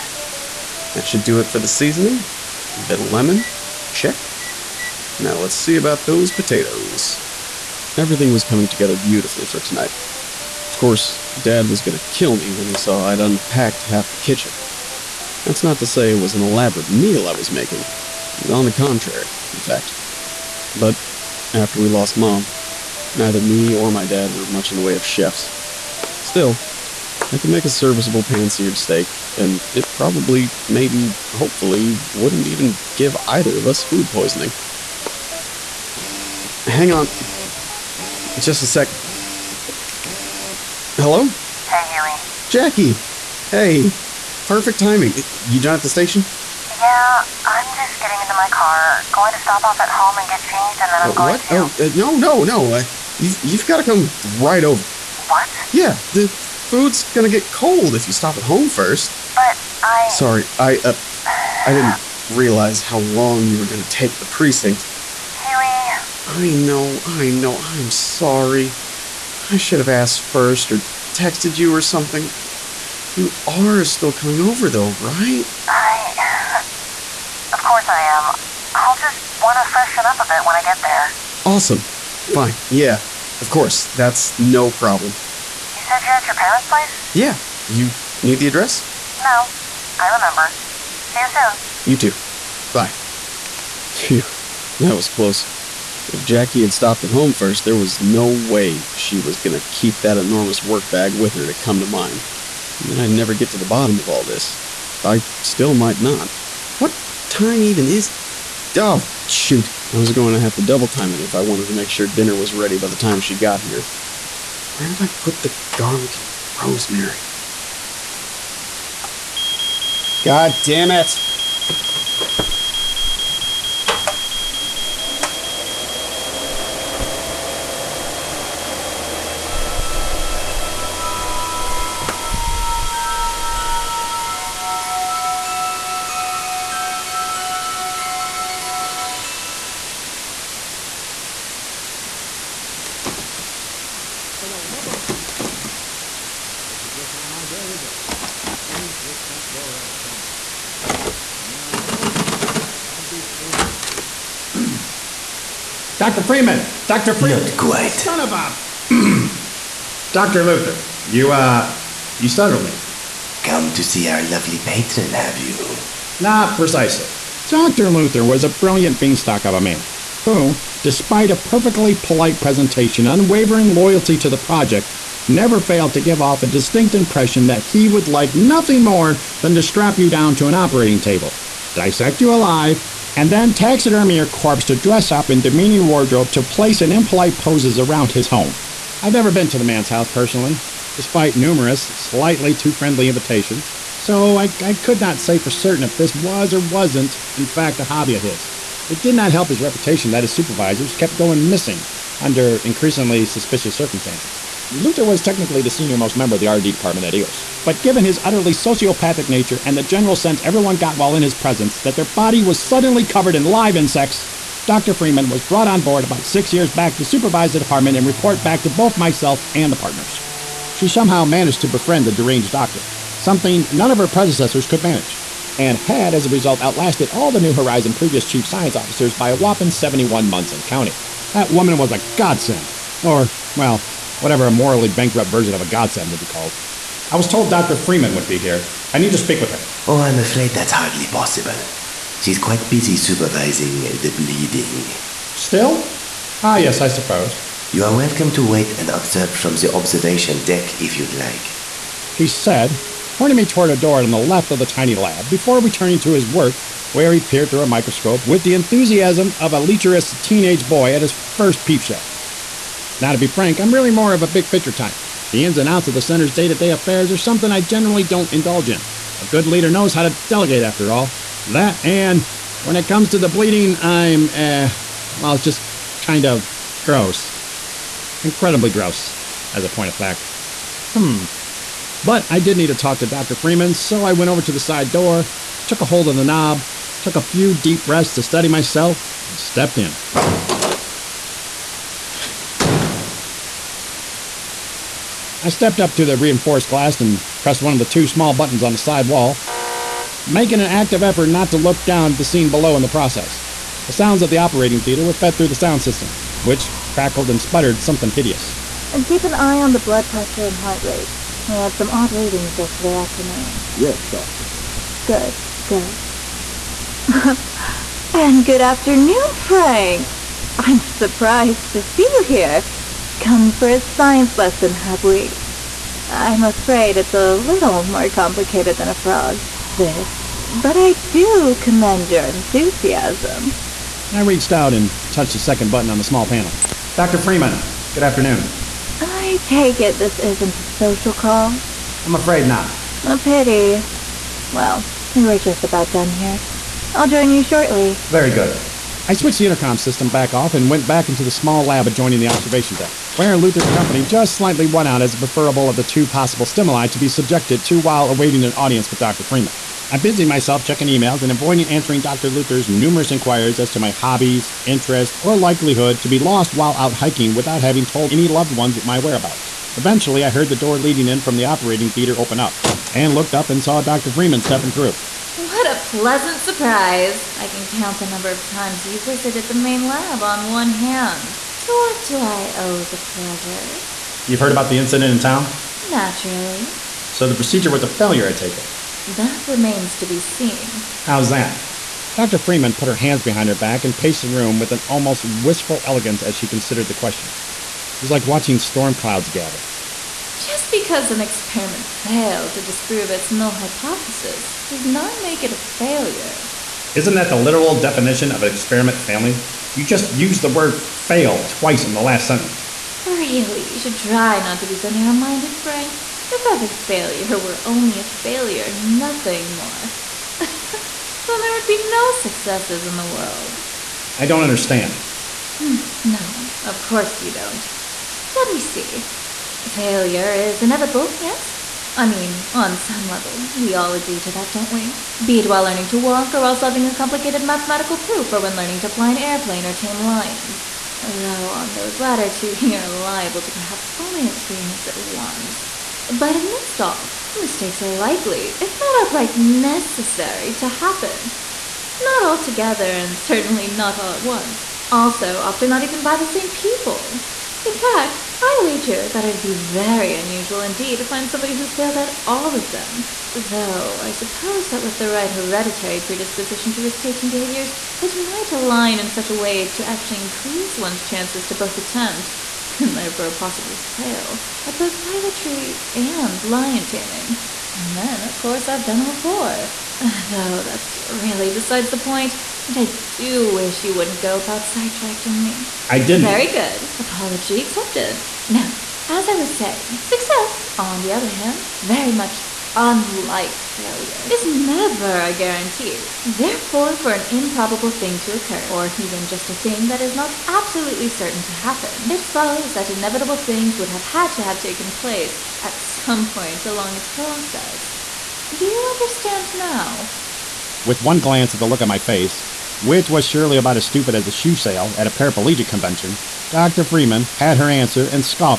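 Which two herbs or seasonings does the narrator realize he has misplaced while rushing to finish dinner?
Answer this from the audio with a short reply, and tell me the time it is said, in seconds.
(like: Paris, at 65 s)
Garlic and rosemary, at 115 s.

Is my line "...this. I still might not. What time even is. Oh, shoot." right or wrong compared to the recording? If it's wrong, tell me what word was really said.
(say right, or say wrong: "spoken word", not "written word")
right.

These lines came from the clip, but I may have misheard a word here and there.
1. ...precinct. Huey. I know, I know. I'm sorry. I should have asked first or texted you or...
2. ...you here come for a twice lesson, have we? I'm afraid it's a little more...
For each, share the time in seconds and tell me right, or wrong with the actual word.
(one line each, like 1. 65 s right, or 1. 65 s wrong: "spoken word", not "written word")
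1. 64 s right
2. 322 s wrong: "science", not "twice".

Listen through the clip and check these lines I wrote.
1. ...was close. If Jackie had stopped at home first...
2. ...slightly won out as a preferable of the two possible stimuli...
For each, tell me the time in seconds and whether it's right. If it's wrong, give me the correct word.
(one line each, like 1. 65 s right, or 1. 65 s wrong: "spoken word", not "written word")
1. 94 s right
2. 354 s right.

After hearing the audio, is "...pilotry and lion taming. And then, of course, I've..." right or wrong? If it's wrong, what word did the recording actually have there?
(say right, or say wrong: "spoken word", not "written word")
right.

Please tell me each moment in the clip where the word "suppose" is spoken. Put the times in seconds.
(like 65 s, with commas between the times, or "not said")
246 s, 464 s.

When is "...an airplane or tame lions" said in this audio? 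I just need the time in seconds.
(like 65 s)
439 s.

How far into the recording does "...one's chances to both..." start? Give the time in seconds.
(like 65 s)
470 s.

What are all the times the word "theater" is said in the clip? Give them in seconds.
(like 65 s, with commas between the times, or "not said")
304 s, 371 s.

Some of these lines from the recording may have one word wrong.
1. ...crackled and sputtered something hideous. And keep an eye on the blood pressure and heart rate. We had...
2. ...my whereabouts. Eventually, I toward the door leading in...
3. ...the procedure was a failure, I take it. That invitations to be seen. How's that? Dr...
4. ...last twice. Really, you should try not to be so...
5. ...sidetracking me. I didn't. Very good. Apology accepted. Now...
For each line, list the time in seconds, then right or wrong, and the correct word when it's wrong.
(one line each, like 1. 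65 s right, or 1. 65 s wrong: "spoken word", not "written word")
1. 306 s right
2. 368 s wrong: "heard", not "toward"
3. 387 s wrong: "remains", not "invitations"
4. 412 s wrong: "sentence", not "twice"
5. 484 s right.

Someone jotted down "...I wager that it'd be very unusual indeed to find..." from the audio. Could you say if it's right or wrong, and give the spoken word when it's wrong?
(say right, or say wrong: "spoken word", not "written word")
right.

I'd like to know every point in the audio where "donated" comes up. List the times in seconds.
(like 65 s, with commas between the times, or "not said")
not said.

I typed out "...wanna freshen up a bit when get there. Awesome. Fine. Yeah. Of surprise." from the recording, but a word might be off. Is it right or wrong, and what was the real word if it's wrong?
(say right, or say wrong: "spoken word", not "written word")
wrong: "course", not "surprise".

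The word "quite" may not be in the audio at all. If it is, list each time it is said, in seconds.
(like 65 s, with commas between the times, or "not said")
157 s, 242 s.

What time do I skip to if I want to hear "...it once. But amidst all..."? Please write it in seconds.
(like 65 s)
444 s.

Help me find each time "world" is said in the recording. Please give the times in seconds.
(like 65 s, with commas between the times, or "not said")
423 s.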